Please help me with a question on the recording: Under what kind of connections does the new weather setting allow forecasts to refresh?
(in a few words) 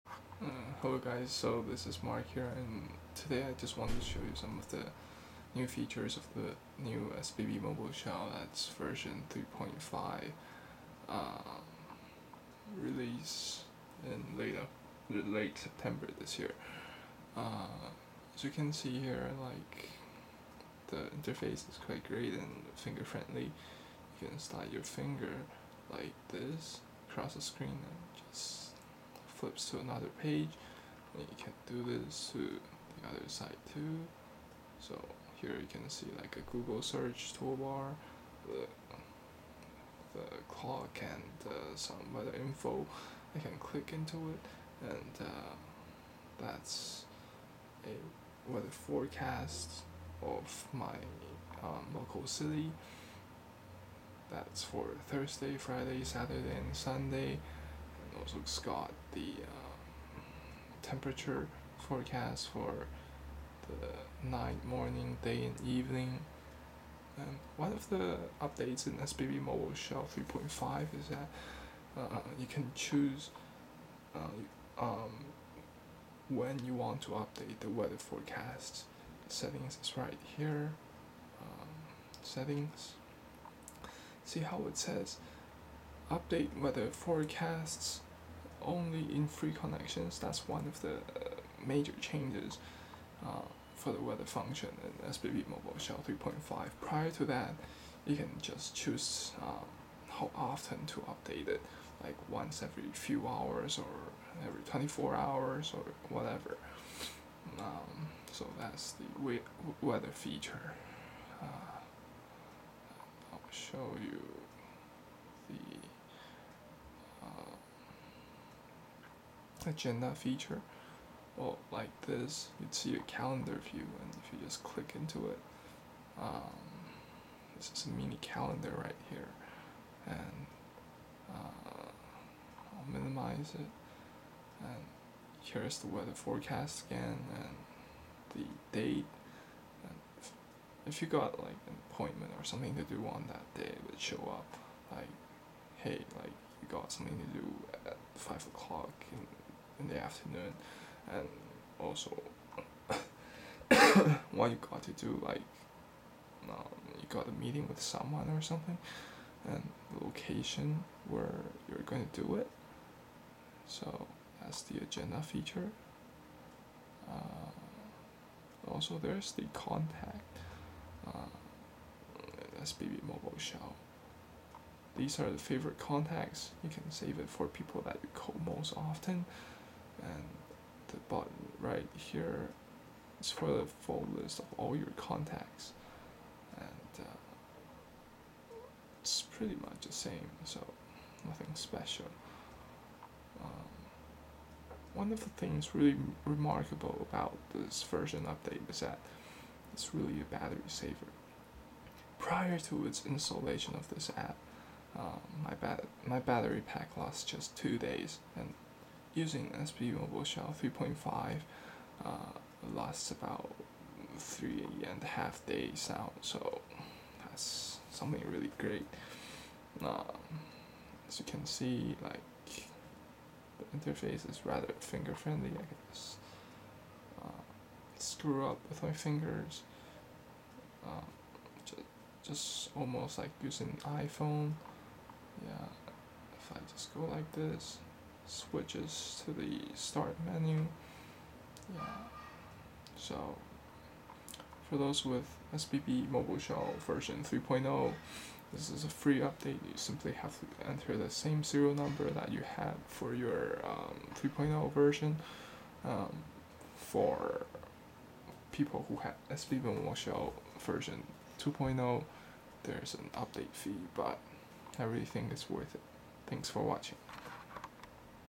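Free connections.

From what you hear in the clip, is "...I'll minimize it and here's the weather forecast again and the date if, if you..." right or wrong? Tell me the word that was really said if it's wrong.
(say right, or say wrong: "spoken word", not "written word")
right.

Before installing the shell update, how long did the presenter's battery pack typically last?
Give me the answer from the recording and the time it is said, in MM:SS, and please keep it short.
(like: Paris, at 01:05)
2 days, at 03:27.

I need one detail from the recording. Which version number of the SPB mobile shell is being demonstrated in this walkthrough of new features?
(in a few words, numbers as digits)
3.5.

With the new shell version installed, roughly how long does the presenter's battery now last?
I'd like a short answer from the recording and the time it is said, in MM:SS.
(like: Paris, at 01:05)
3.5 days, at 03:34.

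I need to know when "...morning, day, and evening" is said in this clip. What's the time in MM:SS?
01:04.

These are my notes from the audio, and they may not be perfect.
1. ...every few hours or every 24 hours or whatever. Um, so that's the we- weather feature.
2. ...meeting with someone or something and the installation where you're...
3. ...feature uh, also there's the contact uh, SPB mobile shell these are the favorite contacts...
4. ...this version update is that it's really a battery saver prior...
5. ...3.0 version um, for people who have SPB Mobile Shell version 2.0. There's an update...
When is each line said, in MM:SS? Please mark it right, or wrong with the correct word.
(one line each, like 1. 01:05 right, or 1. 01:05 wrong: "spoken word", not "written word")
1. 01:42 right
2. 02:37 wrong: "location", not "installation"
3. 02:45 right
4. 03:17 right
5. 04:14 right.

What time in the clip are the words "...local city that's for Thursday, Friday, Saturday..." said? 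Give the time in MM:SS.
00:51.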